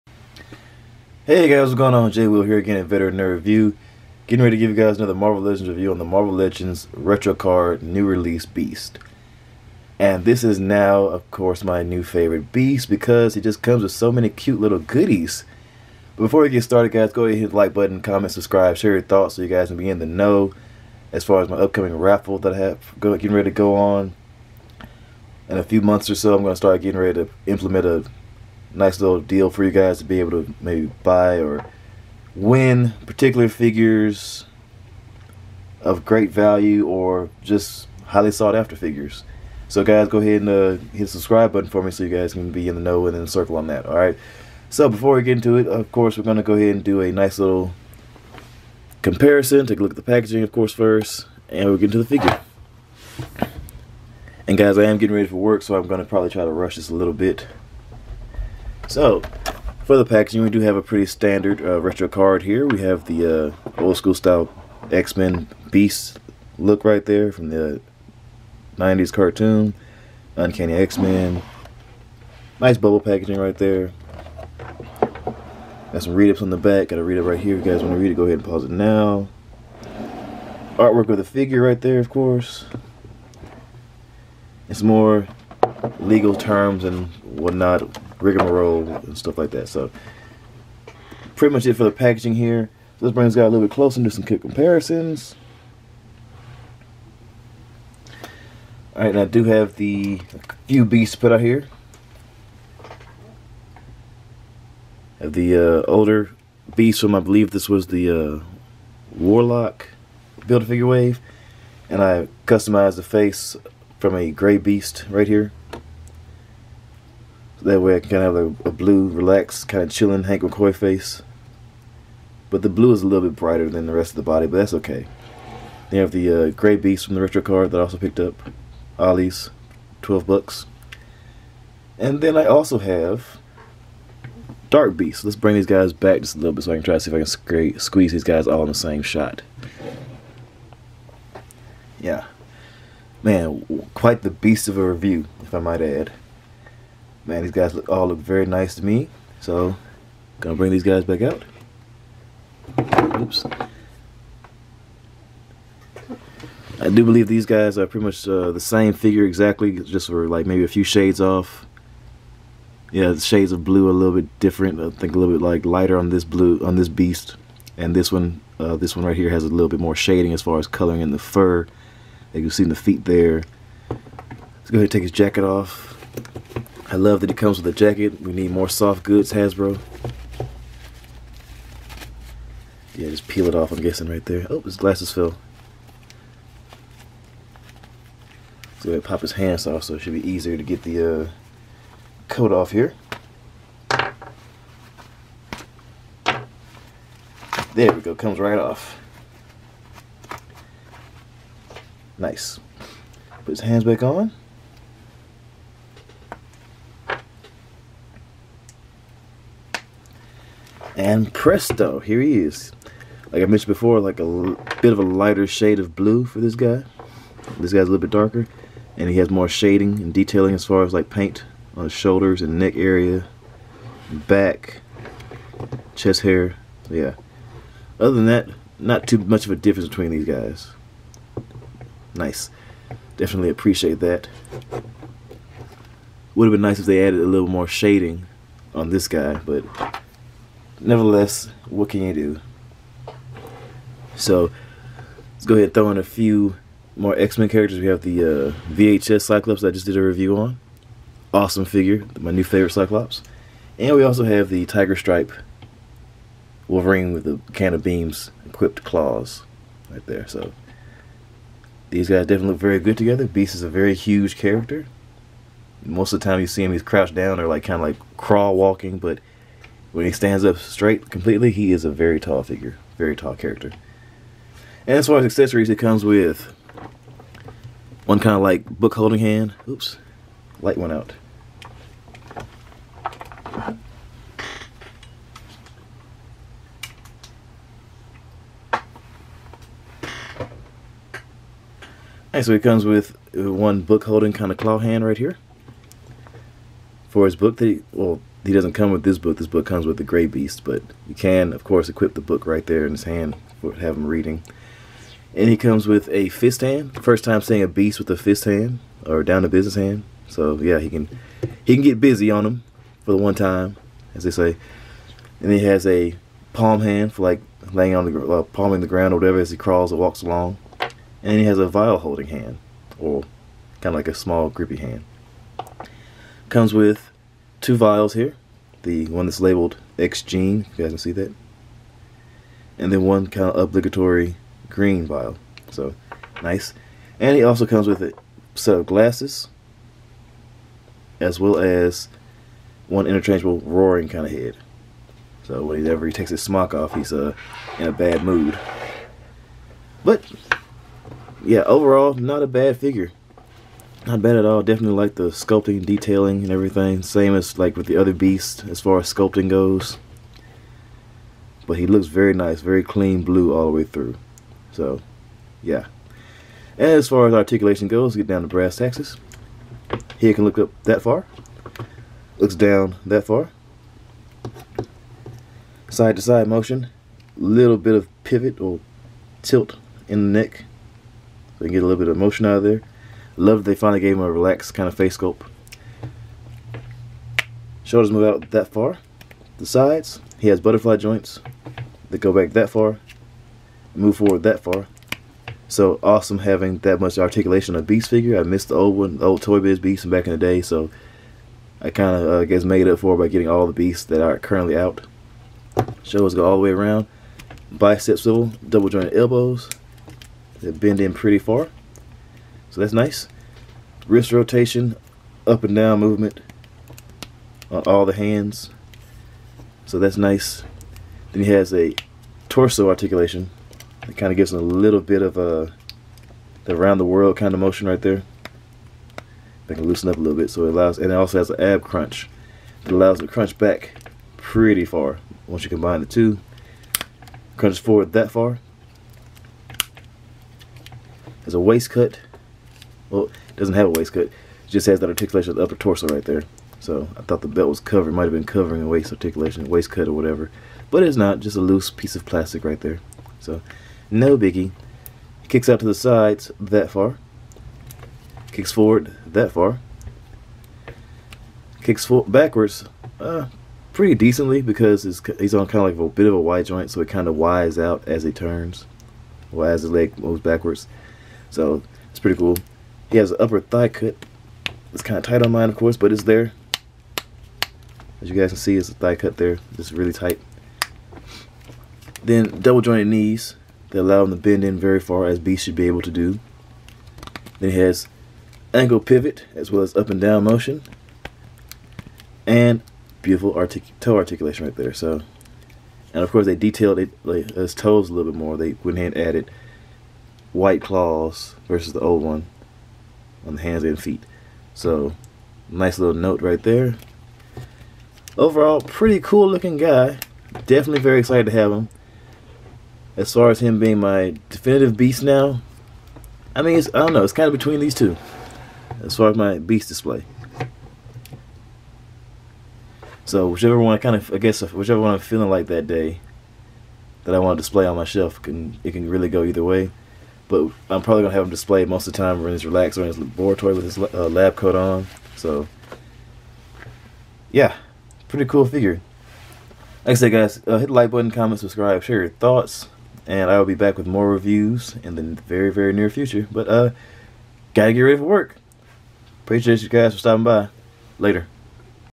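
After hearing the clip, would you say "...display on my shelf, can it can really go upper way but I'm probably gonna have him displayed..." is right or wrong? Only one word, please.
wrong.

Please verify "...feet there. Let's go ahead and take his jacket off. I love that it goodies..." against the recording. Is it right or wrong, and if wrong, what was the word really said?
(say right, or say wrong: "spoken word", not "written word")
wrong: "comes", not "goodies".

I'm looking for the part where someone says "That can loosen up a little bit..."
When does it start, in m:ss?
7:09.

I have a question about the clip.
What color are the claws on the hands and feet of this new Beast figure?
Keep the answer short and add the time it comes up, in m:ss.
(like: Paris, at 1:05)
White, at 8:20.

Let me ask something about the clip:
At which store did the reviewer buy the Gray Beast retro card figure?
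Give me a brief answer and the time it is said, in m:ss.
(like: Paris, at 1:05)
Ollie's, at 2:08.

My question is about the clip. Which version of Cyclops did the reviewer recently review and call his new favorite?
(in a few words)
VHS Cyclops.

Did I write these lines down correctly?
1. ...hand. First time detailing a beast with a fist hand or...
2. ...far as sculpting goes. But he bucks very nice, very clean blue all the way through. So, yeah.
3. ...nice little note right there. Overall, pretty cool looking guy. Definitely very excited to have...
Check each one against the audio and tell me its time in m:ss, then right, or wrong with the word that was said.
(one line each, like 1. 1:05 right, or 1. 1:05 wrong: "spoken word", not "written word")
1. 5:06 wrong: "seeing", not "detailing"
2. 5:58 wrong: "looks", not "bucks"
3. 8:25 right.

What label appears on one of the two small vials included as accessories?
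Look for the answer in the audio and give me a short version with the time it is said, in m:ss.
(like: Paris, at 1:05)
X gene, at 5:29.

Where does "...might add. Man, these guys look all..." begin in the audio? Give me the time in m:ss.
2:25.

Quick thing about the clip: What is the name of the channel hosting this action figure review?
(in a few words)
Veteran Nerd View.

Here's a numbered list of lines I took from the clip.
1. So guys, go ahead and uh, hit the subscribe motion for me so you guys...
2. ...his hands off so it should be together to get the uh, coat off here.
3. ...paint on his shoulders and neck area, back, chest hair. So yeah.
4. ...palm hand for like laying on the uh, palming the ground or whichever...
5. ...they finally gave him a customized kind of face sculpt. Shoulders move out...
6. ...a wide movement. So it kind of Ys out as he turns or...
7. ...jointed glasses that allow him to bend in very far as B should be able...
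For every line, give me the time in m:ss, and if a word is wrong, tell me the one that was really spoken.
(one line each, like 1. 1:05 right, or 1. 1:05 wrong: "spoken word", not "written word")
1. 0:39 wrong: "button", not "motion"
2. 3:09 wrong: "easier", not "together"
3. 3:41 right
4. 5:16 wrong: "whatever", not "whichever"
5. 6:23 wrong: "relaxed", not "customized"
6. 7:46 wrong: "joint", not "movement"
7. 8:02 wrong: "knees", not "glasses".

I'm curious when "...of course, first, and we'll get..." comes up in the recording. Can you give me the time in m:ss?
0:50.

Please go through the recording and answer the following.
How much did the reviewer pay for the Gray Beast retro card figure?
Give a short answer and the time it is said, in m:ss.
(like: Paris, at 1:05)
$12, at 2:10.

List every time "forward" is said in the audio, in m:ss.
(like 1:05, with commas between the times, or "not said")
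6:34, 7:17, 7:38.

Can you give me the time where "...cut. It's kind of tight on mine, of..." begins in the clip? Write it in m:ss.
7:53.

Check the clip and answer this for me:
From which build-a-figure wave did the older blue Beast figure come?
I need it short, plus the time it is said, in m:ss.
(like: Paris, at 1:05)
Warlock, at 1:49.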